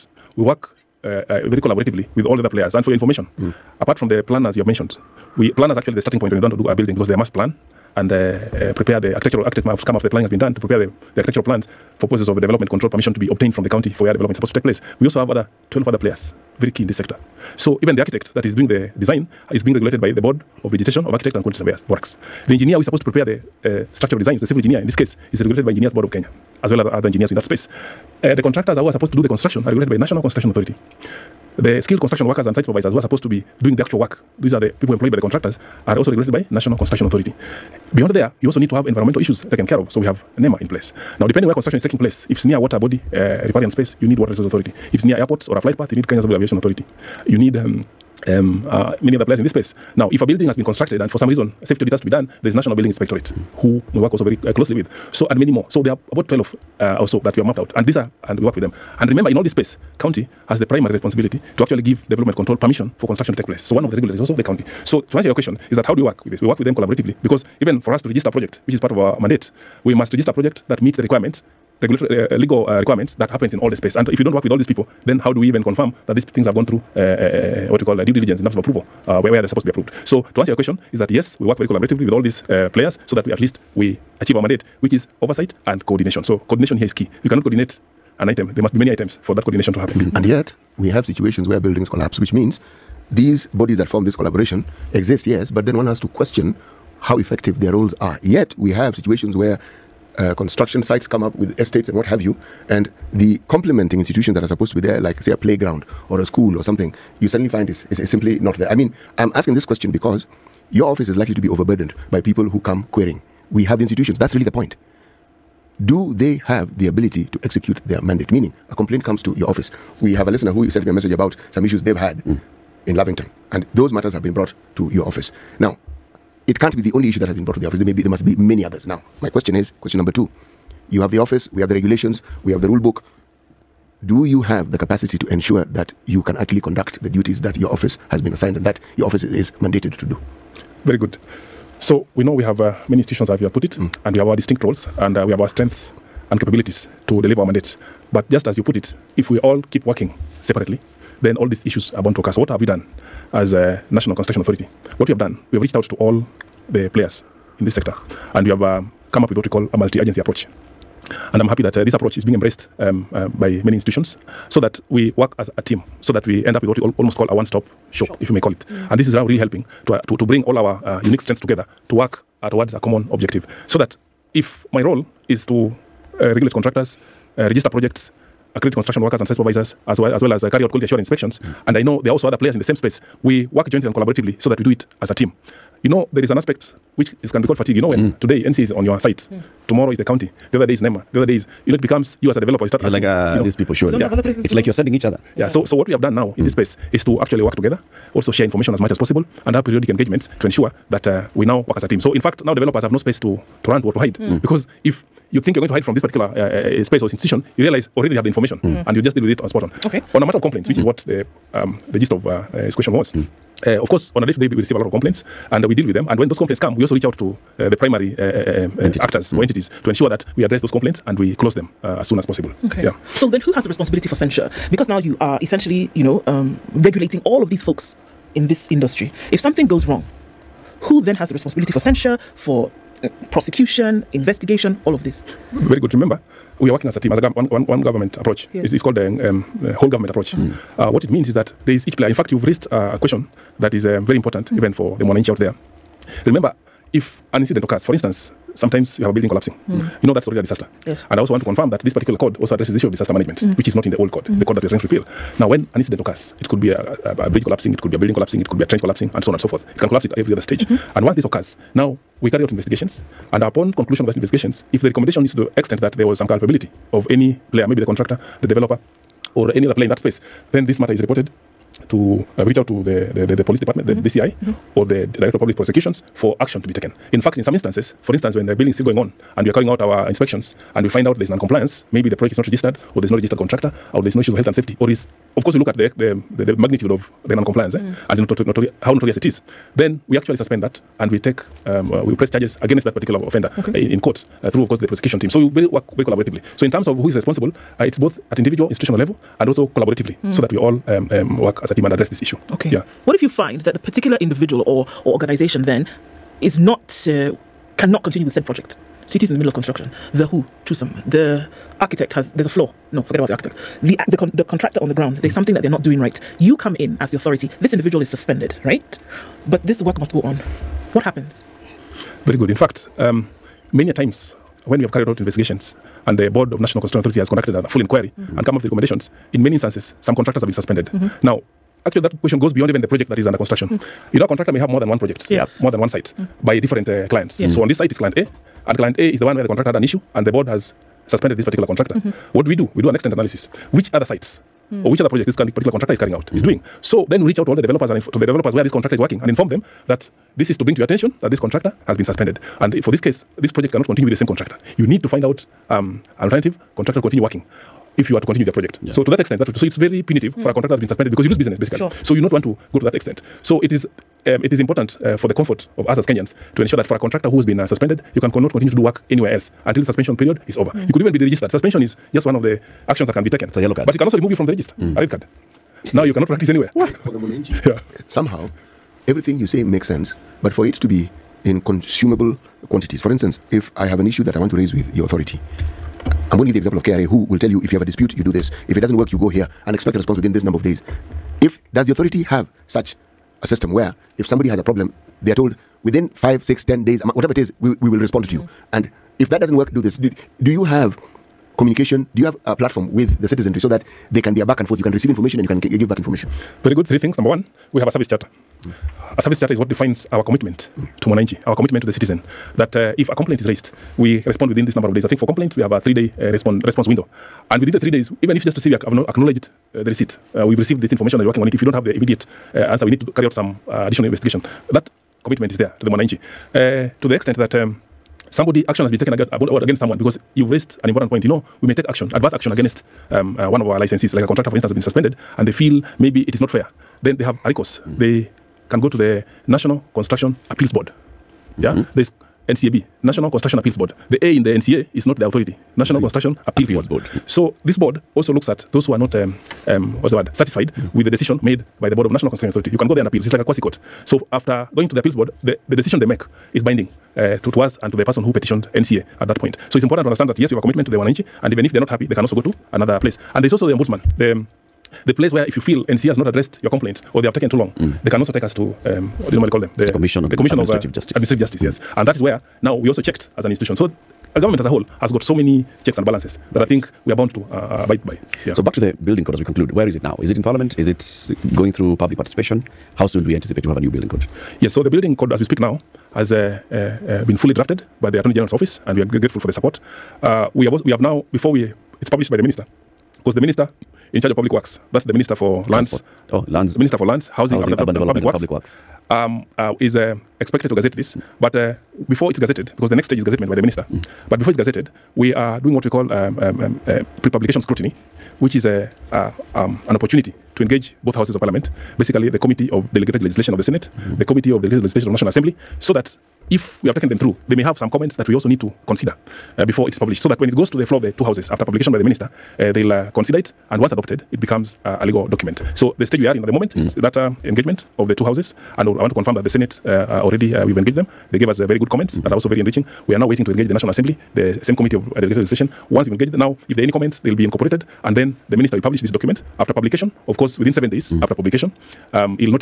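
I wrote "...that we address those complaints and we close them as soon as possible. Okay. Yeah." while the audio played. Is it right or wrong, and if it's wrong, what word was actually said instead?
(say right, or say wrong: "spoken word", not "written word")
right.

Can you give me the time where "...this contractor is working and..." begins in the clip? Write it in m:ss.
5:48.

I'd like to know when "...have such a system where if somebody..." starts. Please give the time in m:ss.
6:32.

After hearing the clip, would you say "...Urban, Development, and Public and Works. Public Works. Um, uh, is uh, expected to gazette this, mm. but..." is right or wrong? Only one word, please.
right.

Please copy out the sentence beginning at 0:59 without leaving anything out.
And remember, in all this space, county has the primary responsibility to actually give development control permission for construction to take place.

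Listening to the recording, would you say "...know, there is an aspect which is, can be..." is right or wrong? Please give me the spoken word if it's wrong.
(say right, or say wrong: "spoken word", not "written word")
right.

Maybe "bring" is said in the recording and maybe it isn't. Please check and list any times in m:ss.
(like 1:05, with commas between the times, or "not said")
2:50, 5:50.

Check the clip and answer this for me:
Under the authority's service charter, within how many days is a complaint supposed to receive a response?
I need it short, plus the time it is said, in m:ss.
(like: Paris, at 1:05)
3, at 6:55.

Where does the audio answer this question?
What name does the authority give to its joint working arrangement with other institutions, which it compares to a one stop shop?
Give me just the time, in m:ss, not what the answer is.
2:39.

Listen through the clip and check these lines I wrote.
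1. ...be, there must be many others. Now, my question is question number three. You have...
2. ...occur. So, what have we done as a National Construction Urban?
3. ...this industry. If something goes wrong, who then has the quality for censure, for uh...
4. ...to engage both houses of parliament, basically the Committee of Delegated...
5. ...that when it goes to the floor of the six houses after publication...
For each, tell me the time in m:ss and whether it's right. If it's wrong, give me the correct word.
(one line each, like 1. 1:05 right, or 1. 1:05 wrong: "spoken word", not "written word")
1. 2:07 wrong: "two", not "three"
2. 2:32 wrong: "Authority", not "Urban"
3. 3:48 wrong: "responsibility", not "quality"
4. 8:30 right
5. 8:40 wrong: "two", not "six".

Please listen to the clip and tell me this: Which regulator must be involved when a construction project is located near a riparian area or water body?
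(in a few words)
Water Resource Authority.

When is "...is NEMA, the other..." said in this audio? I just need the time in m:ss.
3:10.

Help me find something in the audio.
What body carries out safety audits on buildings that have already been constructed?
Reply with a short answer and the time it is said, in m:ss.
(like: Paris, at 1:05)
National Building Inspectorate, at 0:52.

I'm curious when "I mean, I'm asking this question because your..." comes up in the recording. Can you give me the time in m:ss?
1:48.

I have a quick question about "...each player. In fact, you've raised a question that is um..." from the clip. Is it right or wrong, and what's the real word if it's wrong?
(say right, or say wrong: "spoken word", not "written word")
right.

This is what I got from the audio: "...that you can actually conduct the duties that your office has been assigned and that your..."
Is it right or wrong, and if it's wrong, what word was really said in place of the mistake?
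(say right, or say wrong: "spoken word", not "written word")
right.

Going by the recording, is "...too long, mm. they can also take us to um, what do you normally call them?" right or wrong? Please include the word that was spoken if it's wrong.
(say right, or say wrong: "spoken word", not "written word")
right.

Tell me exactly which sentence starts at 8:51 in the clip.
They gave us uh, very good comments mm -hmm.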